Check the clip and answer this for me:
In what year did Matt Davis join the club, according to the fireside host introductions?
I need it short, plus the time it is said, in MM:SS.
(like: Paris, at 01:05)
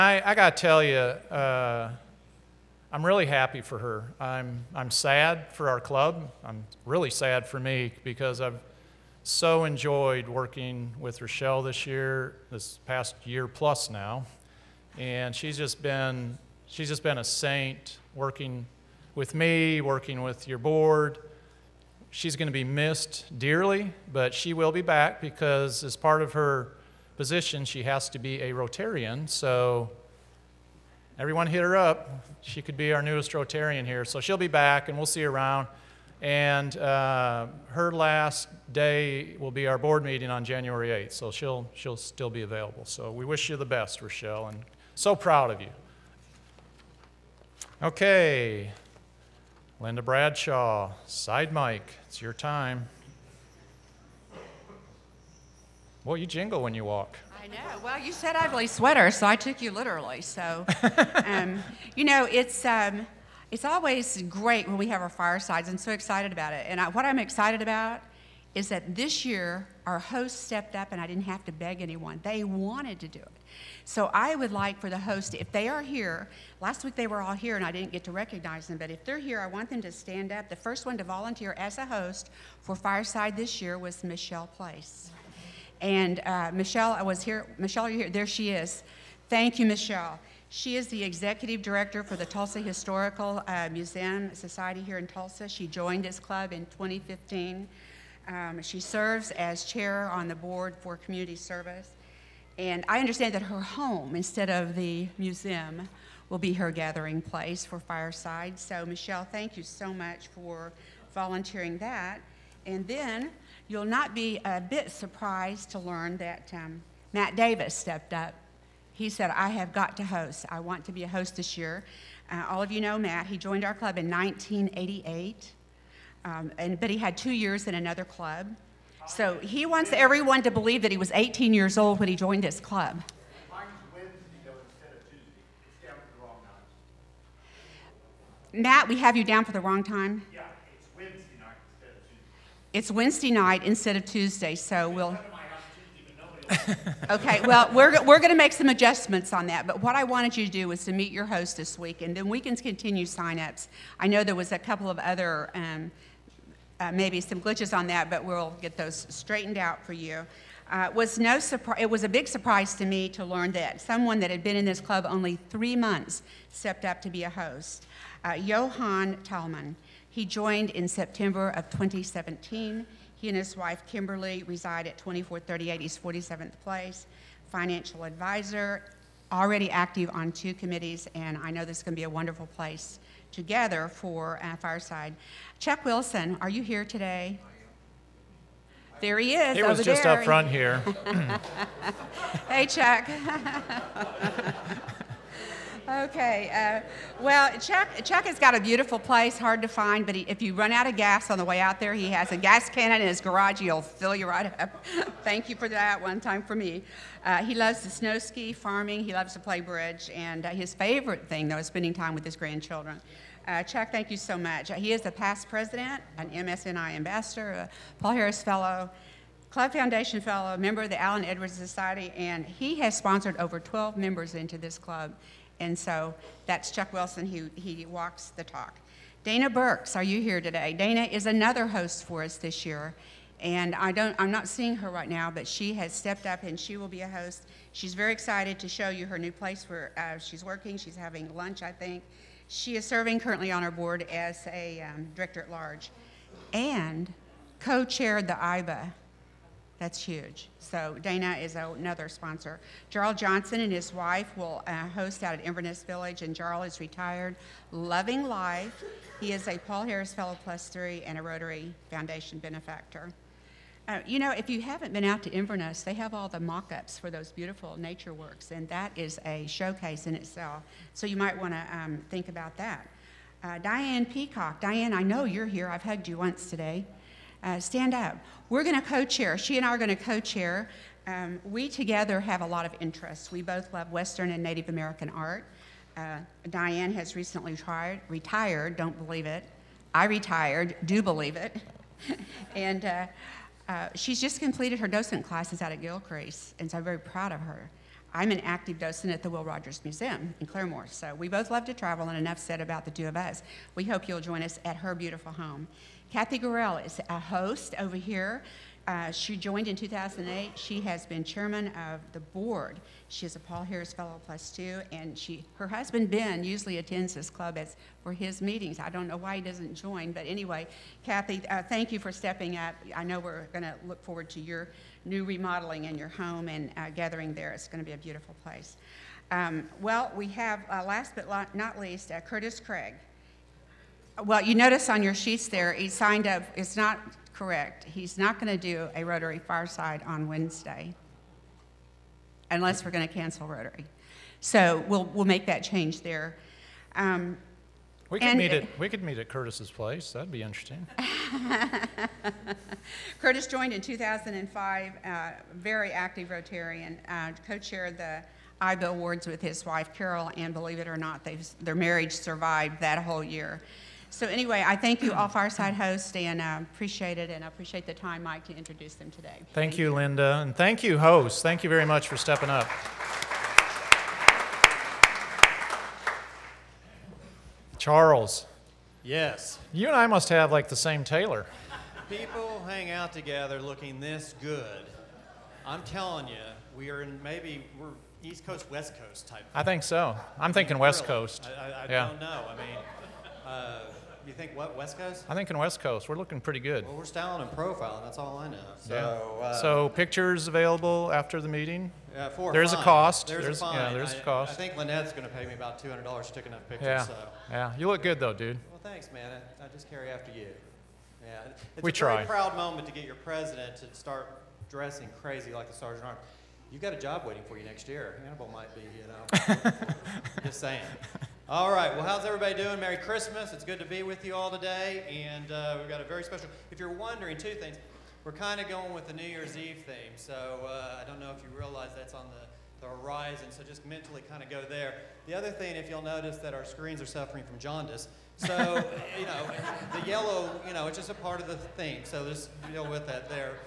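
1988, at 02:04.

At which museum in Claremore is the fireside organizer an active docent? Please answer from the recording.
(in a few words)
Will Rogers Museum.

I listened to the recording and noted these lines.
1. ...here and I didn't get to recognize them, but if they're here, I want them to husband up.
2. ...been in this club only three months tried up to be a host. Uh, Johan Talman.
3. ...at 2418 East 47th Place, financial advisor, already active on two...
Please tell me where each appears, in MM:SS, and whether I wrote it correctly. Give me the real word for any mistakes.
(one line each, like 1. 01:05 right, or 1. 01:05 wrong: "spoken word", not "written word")
1. 01:17 wrong: "stand", not "husband"
2. 02:44 wrong: "stepped", not "tried"
3. 02:54 wrong: "2438", not "2418".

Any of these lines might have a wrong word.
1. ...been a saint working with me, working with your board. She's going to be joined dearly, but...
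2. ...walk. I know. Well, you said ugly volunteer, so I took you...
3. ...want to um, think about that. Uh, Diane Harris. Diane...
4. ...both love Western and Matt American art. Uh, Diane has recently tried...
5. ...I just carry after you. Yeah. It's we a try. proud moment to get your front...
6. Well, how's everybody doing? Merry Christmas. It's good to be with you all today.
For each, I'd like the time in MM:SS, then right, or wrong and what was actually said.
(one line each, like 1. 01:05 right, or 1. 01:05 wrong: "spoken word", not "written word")
1. 00:17 wrong: "missed", not "joined"
2. 00:56 wrong: "sweater", not "volunteer"
3. 04:31 wrong: "Peacock", not "Harris"
4. 04:43 wrong: "Native", not "Matt"
5. 06:49 wrong: "president", not "front"
6. 07:01 right.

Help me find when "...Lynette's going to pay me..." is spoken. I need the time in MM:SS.
06:44.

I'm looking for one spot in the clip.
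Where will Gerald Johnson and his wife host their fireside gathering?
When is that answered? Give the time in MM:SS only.
04:15.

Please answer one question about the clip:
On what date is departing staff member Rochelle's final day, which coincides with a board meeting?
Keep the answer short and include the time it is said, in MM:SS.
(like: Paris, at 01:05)
January 8th, at 00:40.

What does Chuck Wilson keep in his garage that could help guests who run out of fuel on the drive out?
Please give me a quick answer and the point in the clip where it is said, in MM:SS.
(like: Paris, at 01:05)
gas cannon, at 03:22.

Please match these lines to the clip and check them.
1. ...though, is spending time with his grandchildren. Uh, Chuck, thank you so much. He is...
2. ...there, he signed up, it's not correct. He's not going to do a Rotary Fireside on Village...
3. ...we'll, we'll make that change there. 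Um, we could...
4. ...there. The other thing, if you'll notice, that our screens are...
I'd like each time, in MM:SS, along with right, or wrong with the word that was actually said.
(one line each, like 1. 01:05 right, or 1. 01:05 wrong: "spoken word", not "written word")
1. 03:31 right
2. 05:35 wrong: "Wednesday", not "Village"
3. 05:44 right
4. 07:14 right.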